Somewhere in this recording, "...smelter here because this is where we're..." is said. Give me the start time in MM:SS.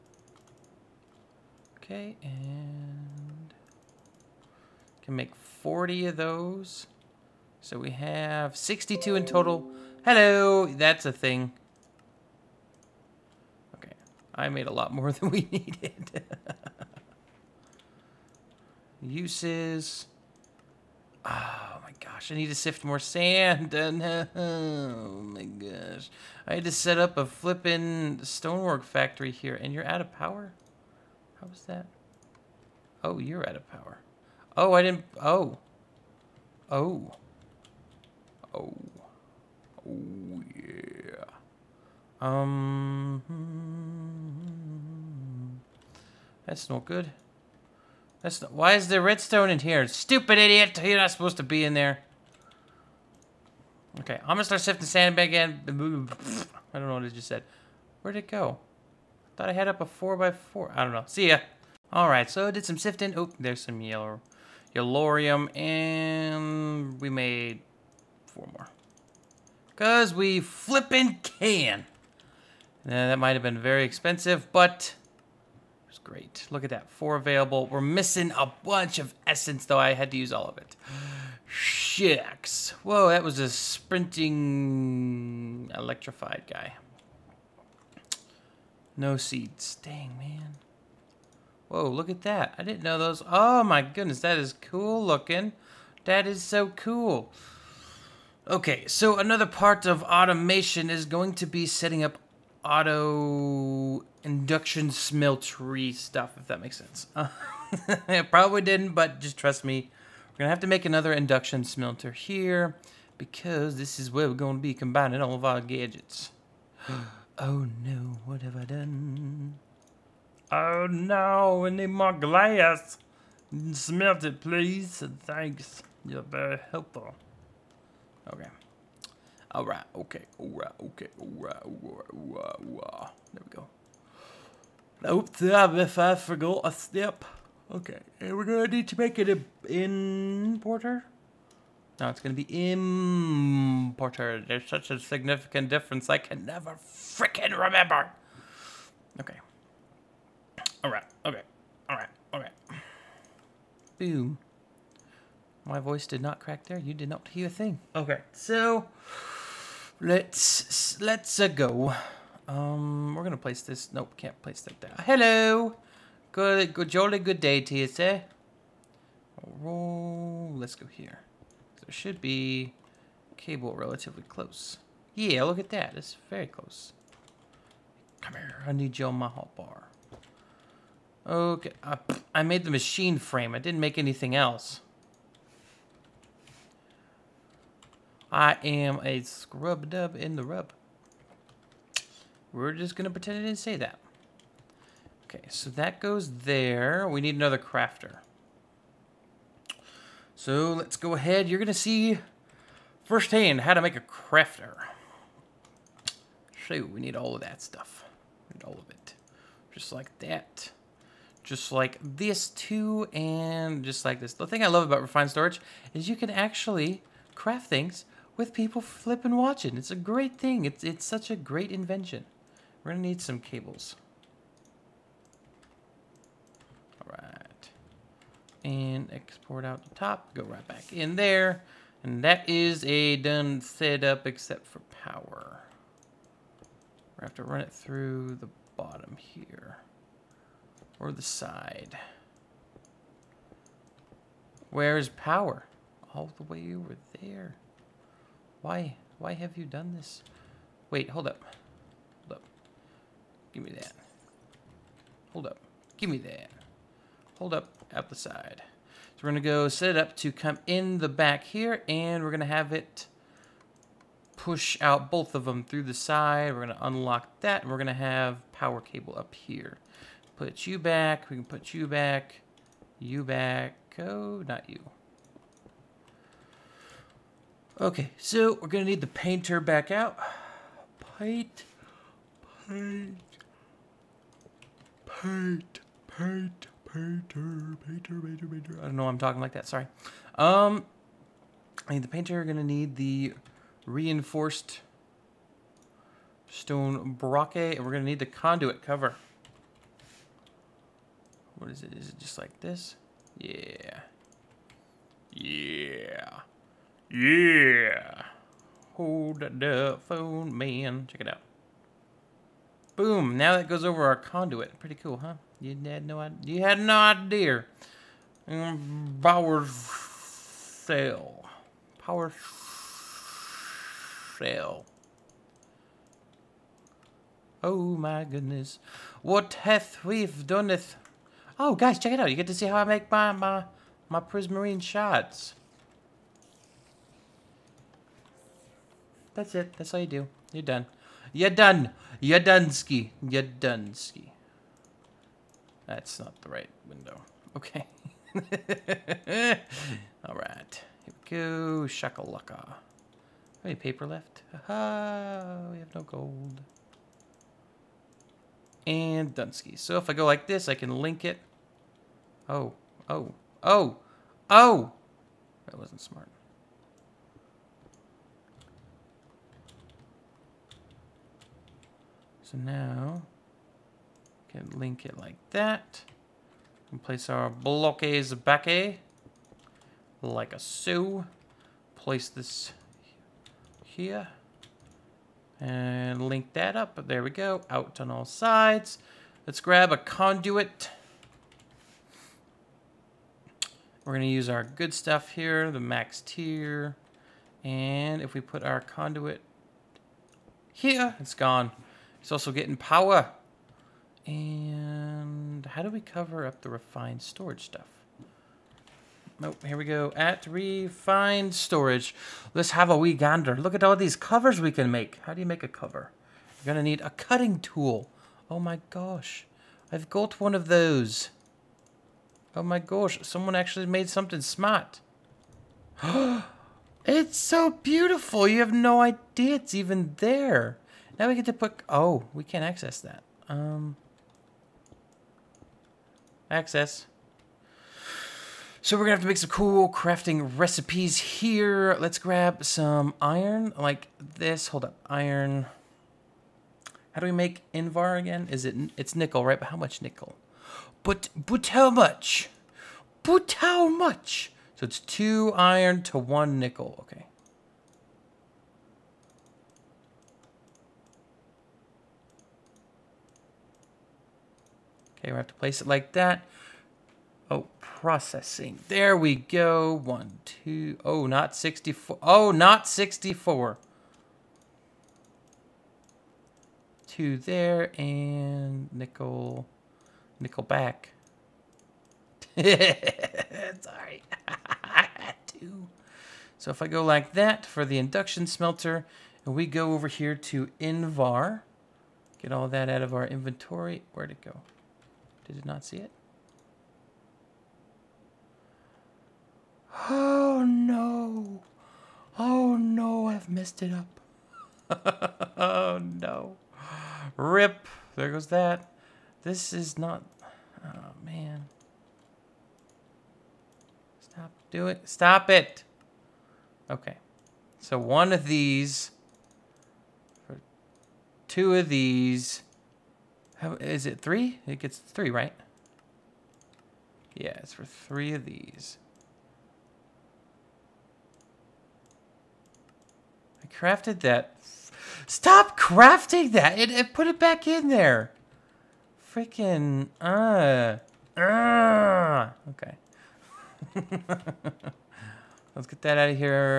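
01:51.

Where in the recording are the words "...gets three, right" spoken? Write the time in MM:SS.
08:44.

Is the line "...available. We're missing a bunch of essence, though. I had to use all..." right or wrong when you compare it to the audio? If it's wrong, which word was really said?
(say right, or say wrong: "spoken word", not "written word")
right.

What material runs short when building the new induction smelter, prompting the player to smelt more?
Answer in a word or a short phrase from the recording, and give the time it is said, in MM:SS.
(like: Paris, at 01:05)
glass, at 02:02.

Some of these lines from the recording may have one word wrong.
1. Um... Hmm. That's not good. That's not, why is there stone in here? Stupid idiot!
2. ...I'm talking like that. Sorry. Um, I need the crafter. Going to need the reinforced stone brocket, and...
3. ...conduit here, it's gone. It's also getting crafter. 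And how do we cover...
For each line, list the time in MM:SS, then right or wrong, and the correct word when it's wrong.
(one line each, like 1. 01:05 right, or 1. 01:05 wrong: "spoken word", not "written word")
1. 00:42 wrong: "redstone", not "stone"
2. 04:49 wrong: "painter", not "crafter"
3. 06:38 wrong: "power", not "crafter".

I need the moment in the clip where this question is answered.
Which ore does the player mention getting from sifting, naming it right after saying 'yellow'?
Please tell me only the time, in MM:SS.
01:04.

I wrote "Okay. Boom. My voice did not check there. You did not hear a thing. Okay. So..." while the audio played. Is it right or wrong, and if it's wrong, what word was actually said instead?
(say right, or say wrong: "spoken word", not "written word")
wrong: "crack", not "check".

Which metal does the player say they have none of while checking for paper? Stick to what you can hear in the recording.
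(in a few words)
gold.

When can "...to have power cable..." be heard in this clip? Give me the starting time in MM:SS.
04:27.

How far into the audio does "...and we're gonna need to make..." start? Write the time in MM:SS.
02:18.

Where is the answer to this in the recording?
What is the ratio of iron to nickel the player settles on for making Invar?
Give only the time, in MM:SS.
07:35.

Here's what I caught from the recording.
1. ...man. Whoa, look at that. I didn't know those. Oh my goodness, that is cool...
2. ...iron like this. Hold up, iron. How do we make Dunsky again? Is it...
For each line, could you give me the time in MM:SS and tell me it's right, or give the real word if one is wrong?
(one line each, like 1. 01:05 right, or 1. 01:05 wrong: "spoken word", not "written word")
1. 01:30 right
2. 07:23 wrong: "Invar", not "Dunsky".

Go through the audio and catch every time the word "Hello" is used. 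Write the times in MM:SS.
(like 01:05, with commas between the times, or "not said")
00:10, 02:45.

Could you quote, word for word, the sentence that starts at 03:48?
and export out the top, go right back in there.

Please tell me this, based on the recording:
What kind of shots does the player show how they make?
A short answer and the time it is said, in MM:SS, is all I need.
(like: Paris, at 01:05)
prismarine shots, at 05:34.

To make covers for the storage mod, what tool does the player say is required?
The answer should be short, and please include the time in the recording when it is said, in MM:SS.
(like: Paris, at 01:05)
a cutting tool, at 06:57.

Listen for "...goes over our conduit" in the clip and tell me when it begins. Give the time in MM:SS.
05:13.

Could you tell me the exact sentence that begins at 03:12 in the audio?
We're just going to pretend I didn't say that.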